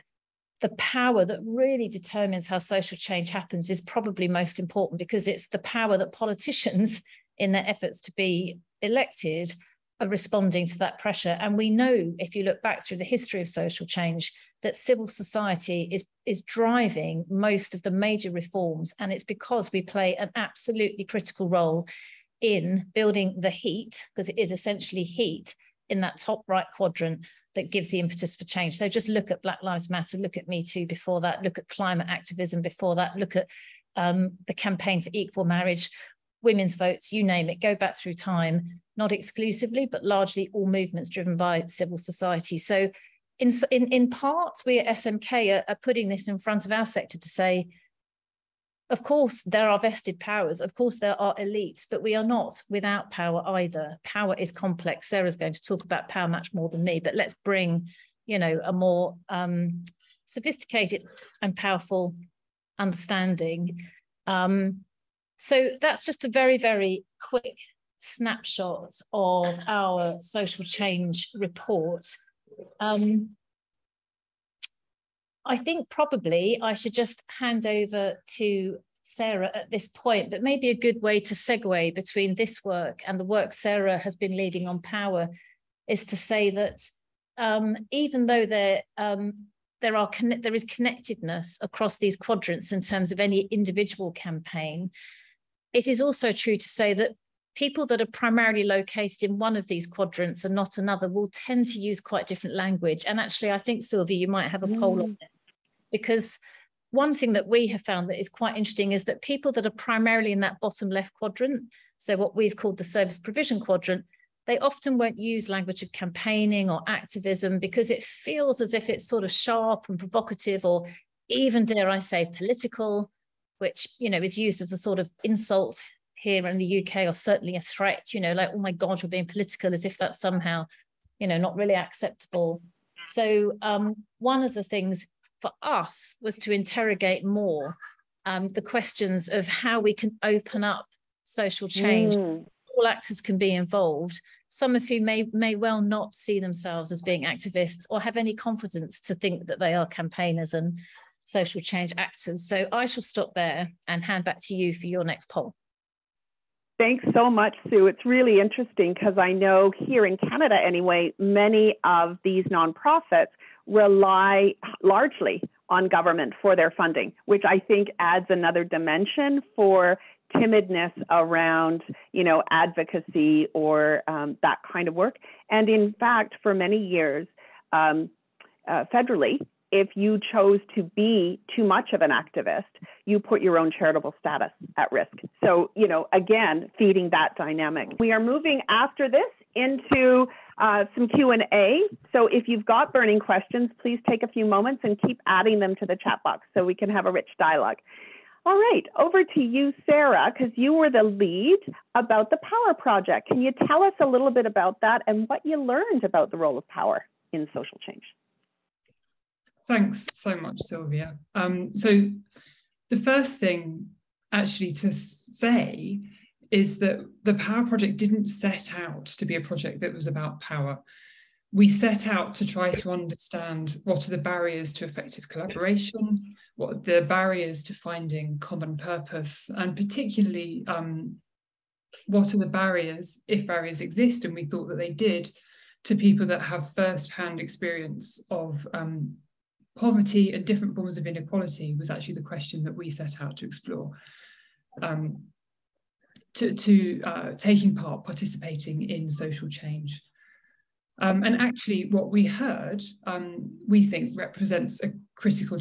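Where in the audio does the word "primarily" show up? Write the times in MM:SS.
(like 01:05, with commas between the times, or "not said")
01:38, 01:49.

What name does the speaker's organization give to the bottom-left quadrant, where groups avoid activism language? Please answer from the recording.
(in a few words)
service provision quadrant.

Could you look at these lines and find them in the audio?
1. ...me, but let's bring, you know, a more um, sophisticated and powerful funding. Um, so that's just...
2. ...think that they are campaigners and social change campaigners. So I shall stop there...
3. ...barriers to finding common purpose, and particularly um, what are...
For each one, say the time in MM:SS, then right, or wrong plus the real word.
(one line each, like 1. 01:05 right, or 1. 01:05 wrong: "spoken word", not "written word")
1. 00:56 wrong: "understanding", not "funding"
2. 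02:29 wrong: "actors", not "campaigners"
3. 03:47 right.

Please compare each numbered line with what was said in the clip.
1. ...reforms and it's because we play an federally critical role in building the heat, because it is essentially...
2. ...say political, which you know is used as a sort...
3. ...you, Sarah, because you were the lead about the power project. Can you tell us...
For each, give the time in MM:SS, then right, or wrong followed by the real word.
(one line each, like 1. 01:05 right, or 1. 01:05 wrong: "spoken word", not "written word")
1. 00:18 wrong: "absolutely", not "federally"
2. 02:01 right
3. 03:19 right.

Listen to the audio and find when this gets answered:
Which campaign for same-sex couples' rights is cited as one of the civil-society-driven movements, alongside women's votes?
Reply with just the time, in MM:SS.
00:35.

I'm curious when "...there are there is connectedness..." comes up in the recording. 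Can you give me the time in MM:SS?
01:29.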